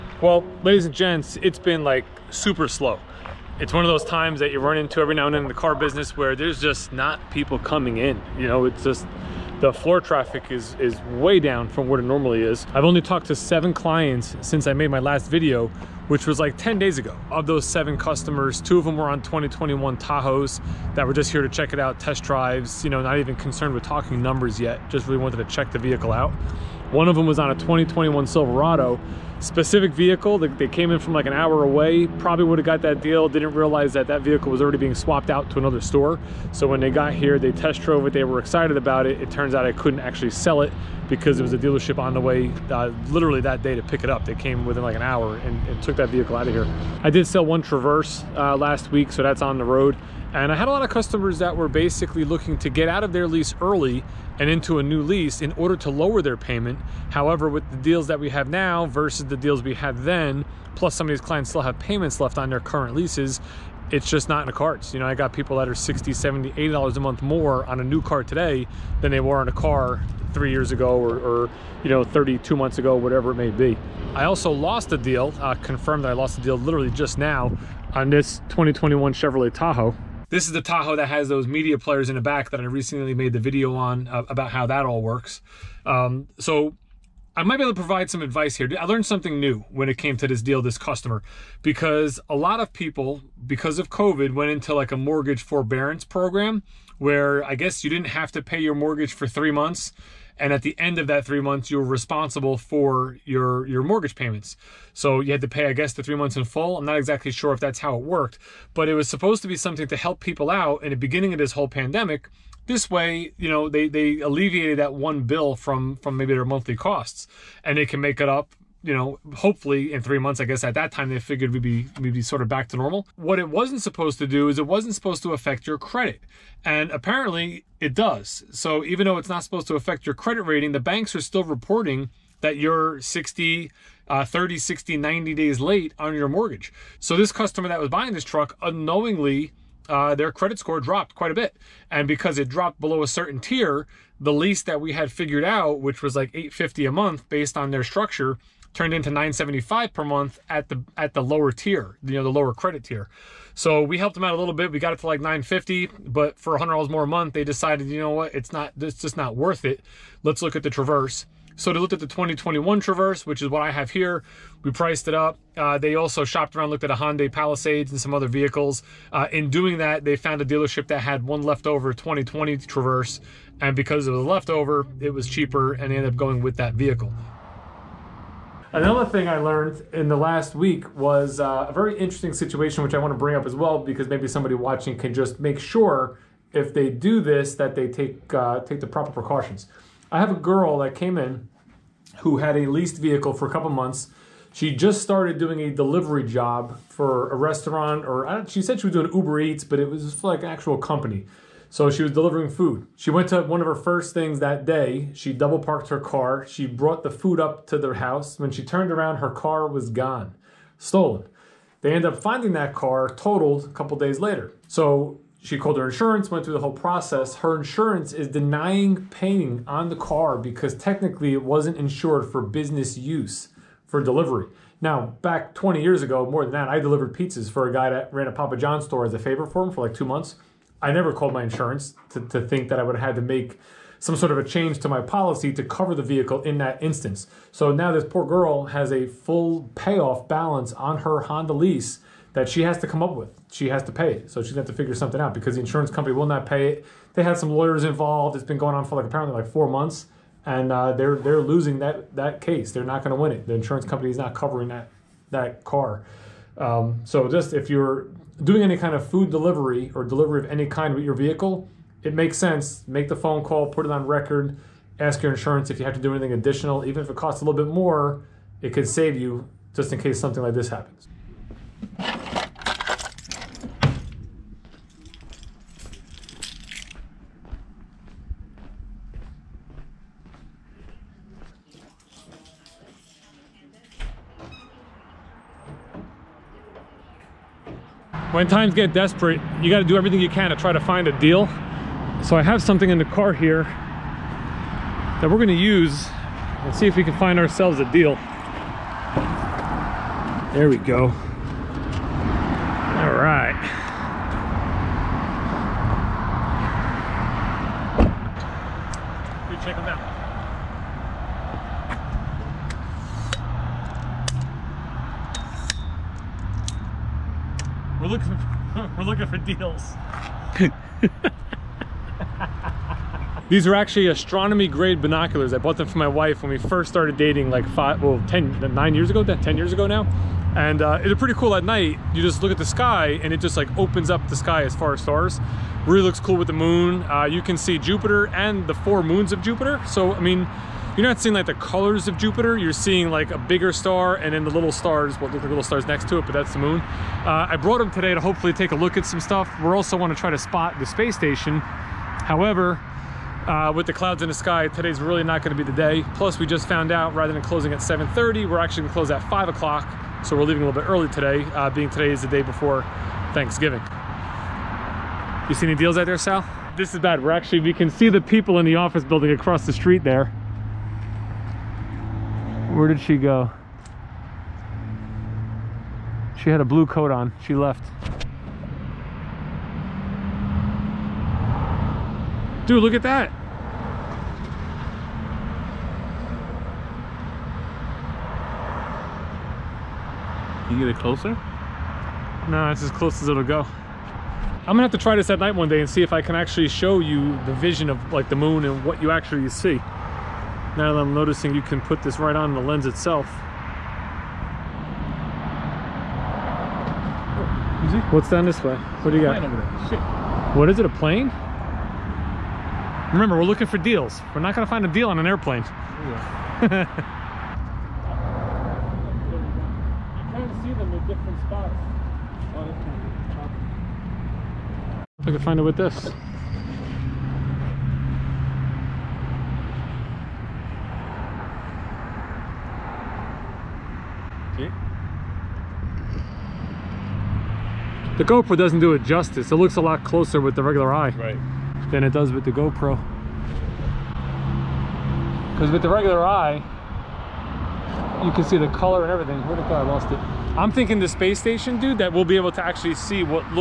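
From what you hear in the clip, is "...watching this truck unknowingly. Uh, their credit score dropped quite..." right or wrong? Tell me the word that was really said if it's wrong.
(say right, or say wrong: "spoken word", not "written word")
wrong: "buying", not "watching".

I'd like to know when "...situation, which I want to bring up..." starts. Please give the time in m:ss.
3:02.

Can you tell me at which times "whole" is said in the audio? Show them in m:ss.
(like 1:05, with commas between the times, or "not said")
1:51, 3:36.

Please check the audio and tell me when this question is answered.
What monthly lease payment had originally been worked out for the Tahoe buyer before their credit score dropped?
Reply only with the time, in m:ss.
2:26.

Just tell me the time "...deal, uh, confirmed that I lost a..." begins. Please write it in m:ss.
1:14.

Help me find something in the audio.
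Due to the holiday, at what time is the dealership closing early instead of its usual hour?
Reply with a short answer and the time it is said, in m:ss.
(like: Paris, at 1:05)
5 o'clock, at 5:59.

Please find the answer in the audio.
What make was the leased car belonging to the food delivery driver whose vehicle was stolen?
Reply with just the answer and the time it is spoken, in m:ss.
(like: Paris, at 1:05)
Honda, at 4:01.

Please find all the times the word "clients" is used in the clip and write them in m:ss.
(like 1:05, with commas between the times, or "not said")
0:13, 1:01.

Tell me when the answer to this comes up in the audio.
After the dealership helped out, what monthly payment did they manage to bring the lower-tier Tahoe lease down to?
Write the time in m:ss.
2:35.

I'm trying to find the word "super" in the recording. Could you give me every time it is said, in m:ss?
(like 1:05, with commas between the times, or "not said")
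0:02.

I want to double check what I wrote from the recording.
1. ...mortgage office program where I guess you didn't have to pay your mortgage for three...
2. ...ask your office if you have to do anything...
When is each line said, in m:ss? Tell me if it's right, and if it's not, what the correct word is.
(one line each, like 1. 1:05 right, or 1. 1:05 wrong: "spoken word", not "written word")
1. 1:34 wrong: "forbearance", not "office"
2. 4:24 wrong: "insurance", not "office".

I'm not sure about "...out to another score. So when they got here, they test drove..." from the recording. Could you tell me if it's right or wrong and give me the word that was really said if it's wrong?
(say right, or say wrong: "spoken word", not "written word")
wrong: "store", not "score".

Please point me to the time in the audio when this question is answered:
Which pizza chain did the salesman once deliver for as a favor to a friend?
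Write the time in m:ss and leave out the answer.
3:48.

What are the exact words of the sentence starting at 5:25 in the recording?
I bought them for my wife when we first started dating like five, well, 10, nine years ago, 10 years ago now.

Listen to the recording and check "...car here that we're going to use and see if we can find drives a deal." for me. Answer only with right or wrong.
wrong.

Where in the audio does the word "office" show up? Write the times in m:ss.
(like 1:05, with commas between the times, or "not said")
6:08.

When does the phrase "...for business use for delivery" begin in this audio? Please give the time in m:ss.
3:42.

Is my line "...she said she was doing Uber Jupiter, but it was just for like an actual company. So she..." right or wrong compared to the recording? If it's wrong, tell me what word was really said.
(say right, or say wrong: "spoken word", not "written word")
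wrong: "Eats", not "Jupiter".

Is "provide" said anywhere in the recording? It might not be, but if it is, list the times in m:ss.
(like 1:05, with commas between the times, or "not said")
1:27.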